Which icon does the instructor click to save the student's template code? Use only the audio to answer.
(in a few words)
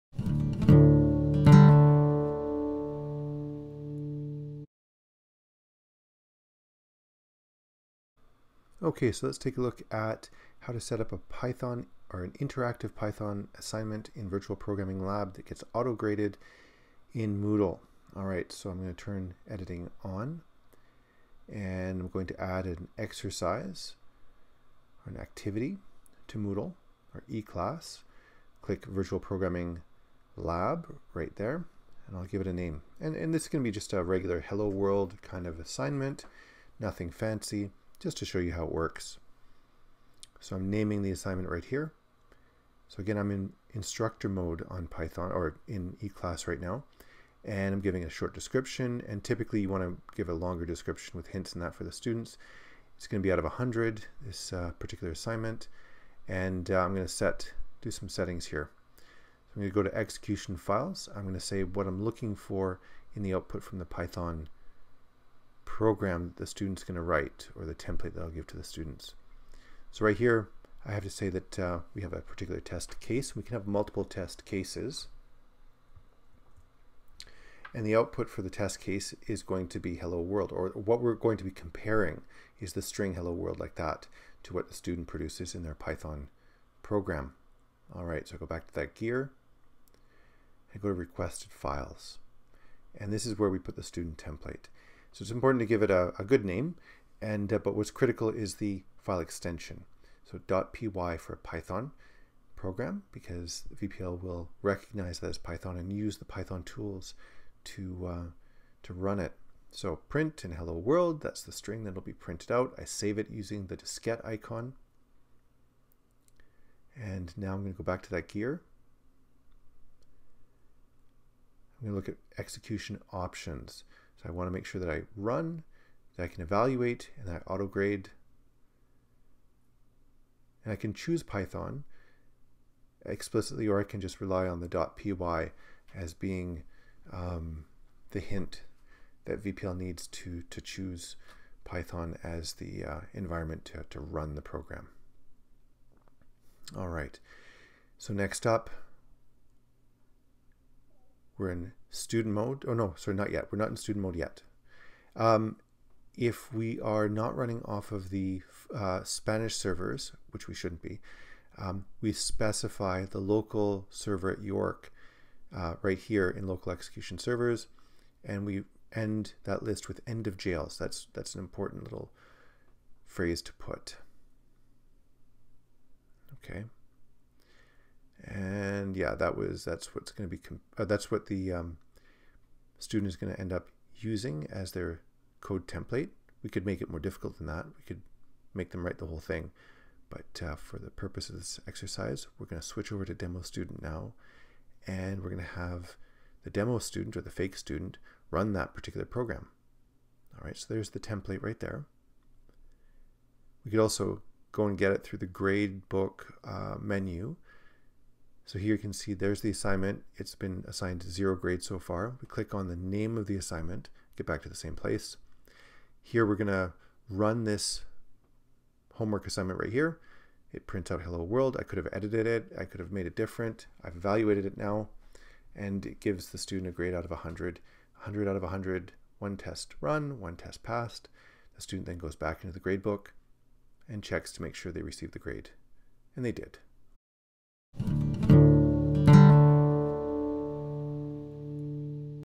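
diskette icon.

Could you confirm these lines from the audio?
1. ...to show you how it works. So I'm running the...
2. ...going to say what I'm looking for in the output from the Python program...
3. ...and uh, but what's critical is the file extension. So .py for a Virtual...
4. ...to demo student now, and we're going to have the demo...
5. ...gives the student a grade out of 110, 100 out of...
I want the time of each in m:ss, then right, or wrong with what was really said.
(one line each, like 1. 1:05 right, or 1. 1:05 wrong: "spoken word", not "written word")
1. 0:38 wrong: "naming", not "running"
2. 1:01 right
3. 1:37 wrong: "Python", not "Virtual"
4. 3:13 right
5. 3:45 wrong: "100", not "110".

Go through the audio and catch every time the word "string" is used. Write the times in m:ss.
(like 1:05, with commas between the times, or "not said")
1:22, 1:51.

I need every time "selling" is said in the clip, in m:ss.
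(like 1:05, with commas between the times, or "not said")
not said.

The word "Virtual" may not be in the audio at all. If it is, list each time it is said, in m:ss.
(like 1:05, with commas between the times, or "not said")
0:14, 0:28.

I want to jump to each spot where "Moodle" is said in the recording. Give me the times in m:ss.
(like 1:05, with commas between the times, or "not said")
0:17, 0:26.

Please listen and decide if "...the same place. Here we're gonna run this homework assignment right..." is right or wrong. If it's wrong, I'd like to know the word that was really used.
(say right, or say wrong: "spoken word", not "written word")
right.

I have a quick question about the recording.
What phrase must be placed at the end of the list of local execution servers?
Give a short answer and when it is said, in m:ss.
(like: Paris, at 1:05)
end of jails, at 2:50.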